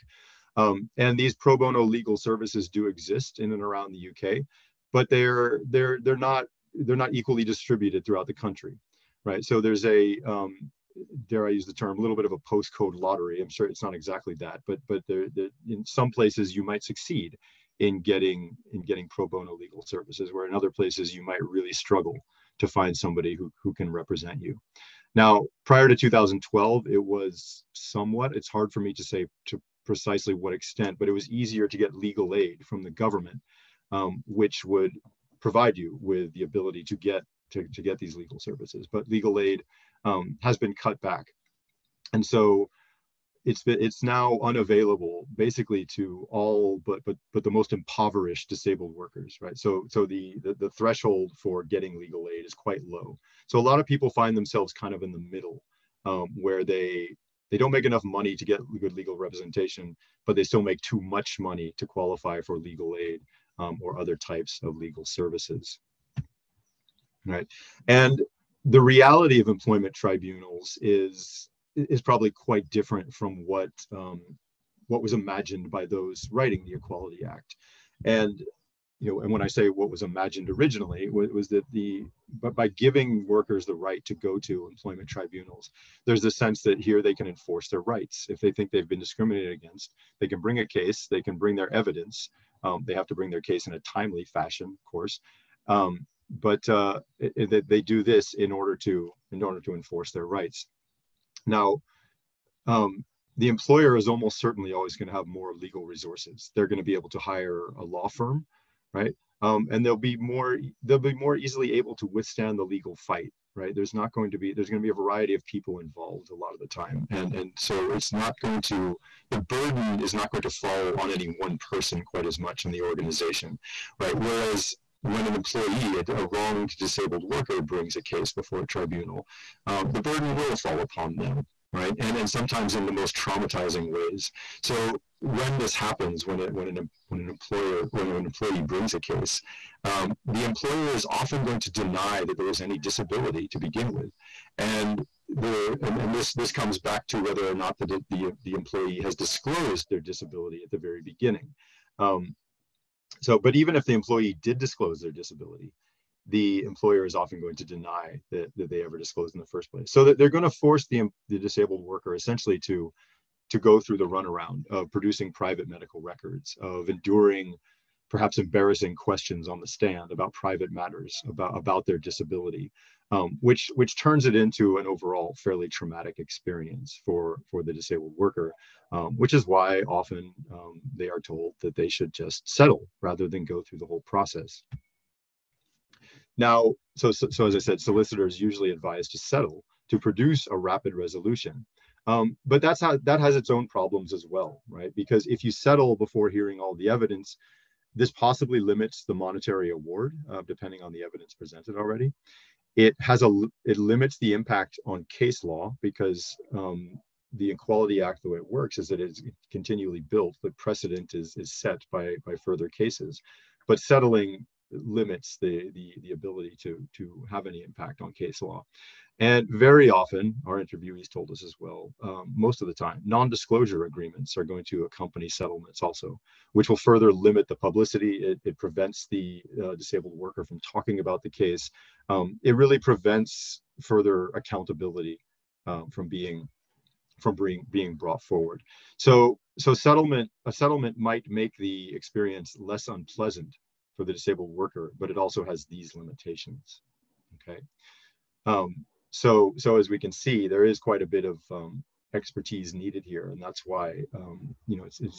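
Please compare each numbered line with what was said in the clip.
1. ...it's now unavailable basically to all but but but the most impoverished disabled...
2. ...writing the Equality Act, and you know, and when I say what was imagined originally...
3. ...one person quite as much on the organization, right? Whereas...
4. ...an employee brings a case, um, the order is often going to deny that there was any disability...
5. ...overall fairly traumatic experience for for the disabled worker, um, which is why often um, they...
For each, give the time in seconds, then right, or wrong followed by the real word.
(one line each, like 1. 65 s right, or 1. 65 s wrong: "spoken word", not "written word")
1. 43 s right
2. 76 s right
3. 121 s right
4. 138 s wrong: "employer", not "order"
5. 174 s right.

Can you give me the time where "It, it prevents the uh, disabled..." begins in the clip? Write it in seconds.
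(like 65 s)
228 s.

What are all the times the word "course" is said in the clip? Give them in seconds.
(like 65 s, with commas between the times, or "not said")
94 s.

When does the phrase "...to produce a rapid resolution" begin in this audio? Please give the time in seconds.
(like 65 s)
189 s.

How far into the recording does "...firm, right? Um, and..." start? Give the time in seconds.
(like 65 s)
108 s.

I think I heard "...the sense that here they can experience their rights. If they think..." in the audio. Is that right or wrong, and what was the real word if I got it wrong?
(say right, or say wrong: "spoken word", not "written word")
wrong: "enforce", not "experience".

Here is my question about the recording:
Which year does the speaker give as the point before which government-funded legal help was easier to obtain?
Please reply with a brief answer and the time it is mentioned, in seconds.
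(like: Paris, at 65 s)
2012, at 25 s.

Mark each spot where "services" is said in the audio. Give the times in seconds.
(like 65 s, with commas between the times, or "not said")
2 s, 19 s, 38 s, 65 s.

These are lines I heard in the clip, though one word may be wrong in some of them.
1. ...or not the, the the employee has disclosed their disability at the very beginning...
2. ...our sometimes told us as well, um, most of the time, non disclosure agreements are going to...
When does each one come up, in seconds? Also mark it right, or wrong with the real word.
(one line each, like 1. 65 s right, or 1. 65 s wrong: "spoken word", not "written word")
1. 147 s right
2. 220 s wrong: "interviewees", not "sometimes".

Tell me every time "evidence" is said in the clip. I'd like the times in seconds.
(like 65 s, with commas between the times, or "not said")
91 s, 196 s, 201 s.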